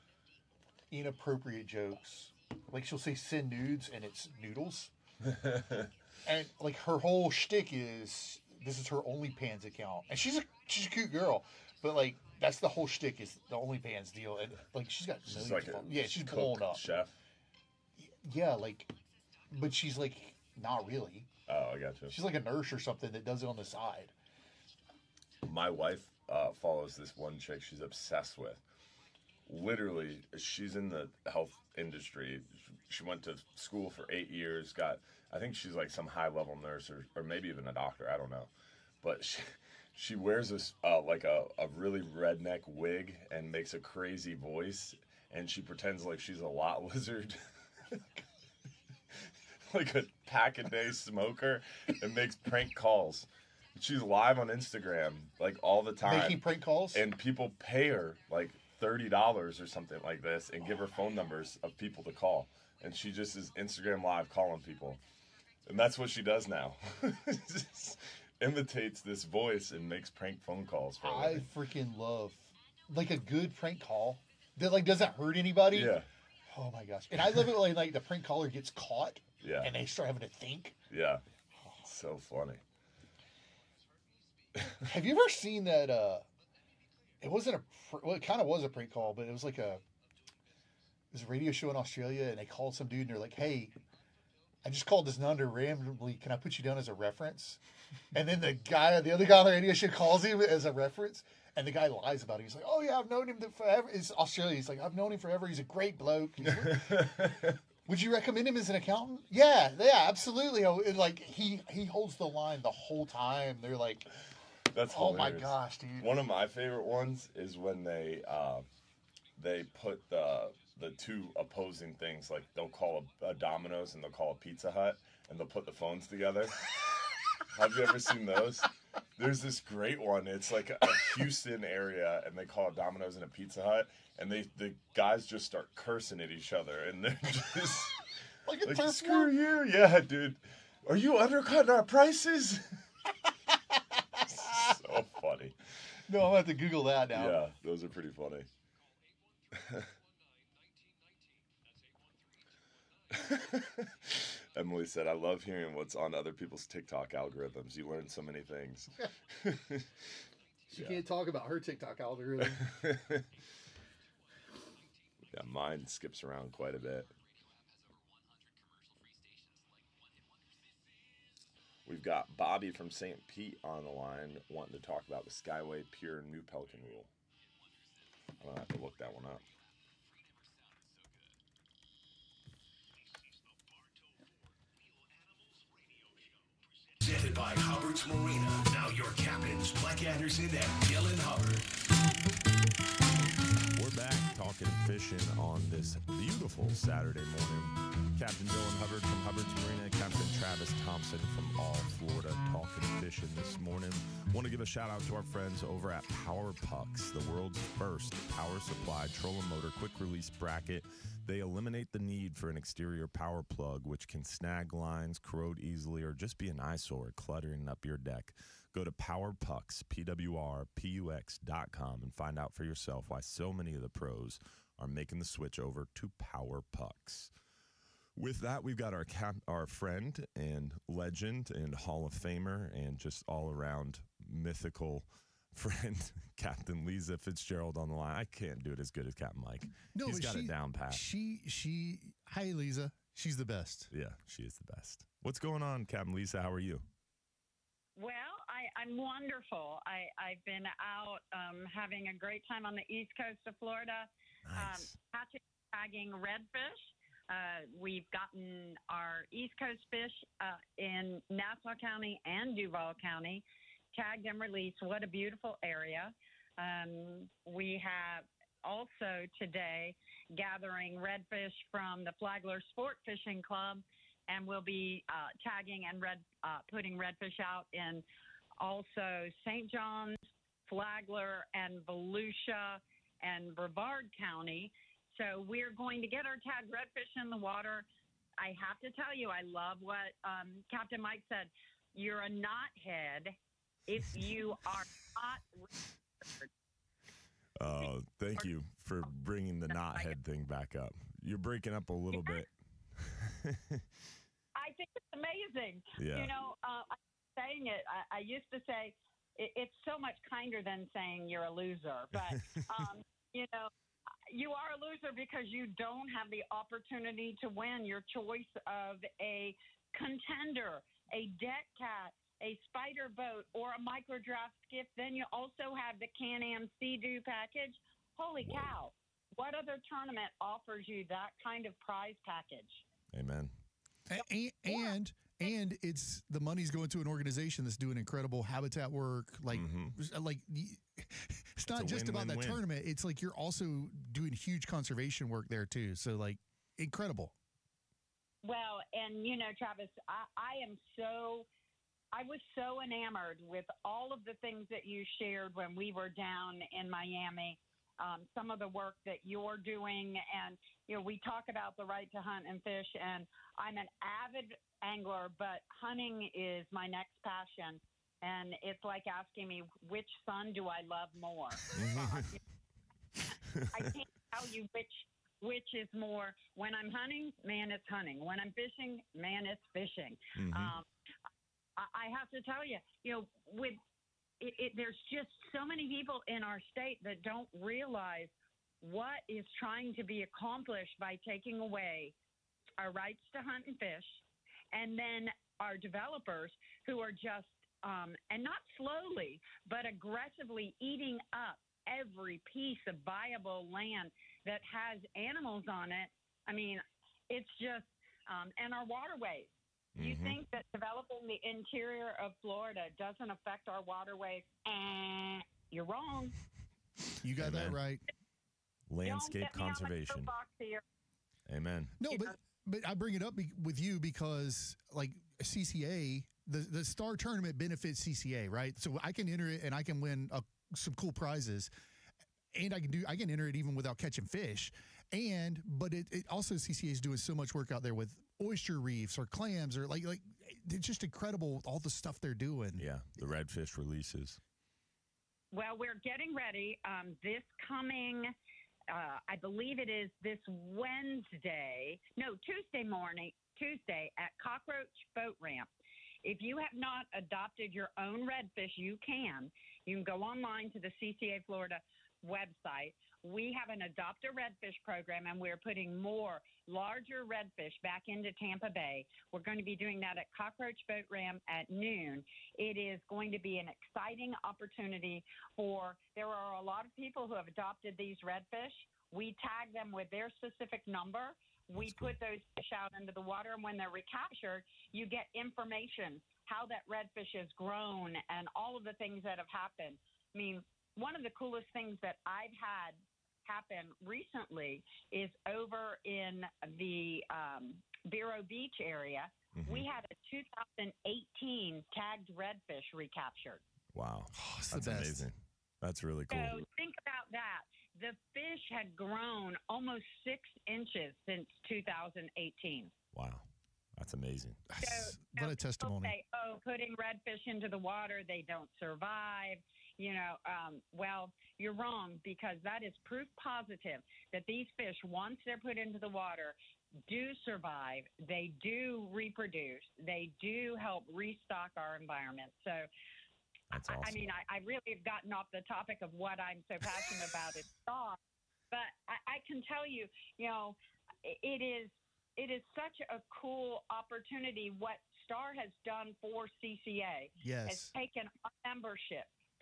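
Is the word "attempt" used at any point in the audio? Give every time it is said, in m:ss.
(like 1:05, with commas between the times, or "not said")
not said.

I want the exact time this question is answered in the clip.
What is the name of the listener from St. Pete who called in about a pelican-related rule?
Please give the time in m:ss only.
2:52.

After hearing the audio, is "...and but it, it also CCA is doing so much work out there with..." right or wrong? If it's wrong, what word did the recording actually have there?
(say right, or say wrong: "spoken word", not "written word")
right.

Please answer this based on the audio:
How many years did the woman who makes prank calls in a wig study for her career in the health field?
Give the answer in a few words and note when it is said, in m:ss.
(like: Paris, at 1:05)
8, at 0:34.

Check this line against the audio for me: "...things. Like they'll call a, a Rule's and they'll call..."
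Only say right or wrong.
wrong.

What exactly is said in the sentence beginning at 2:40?
can't talk about her TikTok algorithm.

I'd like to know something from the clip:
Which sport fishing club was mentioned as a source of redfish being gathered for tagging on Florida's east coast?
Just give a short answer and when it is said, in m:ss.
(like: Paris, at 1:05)
Flagler Sport Fishing Club, at 4:32.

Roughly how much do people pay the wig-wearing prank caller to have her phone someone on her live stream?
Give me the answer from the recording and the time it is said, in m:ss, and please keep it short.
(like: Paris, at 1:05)
$30, at 0:58.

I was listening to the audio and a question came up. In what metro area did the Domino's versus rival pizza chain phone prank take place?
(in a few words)
Houston.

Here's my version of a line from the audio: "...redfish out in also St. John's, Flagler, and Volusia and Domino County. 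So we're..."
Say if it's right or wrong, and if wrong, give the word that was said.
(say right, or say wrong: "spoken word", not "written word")
wrong: "Brevard", not "Domino".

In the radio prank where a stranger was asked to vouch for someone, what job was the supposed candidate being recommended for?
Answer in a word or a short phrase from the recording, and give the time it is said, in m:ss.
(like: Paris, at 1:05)
Accountant, at 1:48.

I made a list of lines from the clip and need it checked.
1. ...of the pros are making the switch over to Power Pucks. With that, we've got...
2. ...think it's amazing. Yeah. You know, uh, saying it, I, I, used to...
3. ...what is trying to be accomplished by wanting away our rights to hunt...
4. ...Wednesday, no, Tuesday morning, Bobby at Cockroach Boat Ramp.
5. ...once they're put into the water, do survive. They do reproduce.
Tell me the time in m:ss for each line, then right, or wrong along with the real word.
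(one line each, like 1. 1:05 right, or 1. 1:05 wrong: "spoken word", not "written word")
1. 3:43 right
2. 5:04 right
3. 6:28 wrong: "taking", not "wanting"
4. 7:30 wrong: "Tuesday", not "Bobby"
5. 8:45 right.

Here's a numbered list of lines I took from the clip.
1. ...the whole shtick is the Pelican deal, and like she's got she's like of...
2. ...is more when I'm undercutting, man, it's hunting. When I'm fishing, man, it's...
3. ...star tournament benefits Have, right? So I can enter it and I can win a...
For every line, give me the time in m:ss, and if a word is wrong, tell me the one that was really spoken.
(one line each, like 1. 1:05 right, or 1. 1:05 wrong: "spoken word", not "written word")
1. 0:12 wrong: "OnlyFans", not "Pelican"
2. 6:15 wrong: "hunting", not "undercutting"
3. 7:06 wrong: "CCA", not "Have".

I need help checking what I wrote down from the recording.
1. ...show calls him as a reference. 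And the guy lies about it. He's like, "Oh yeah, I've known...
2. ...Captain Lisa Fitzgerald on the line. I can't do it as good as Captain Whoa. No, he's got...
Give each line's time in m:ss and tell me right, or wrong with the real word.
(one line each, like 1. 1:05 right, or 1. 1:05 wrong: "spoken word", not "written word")
1. 1:39 right
2. 3:56 wrong: "Mike", not "Whoa".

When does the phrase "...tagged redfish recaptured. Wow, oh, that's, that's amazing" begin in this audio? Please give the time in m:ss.
8:21.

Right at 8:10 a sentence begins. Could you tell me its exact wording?
I mean, one of the coolest things that I've had happened recently is over in the um, Vero Beach area.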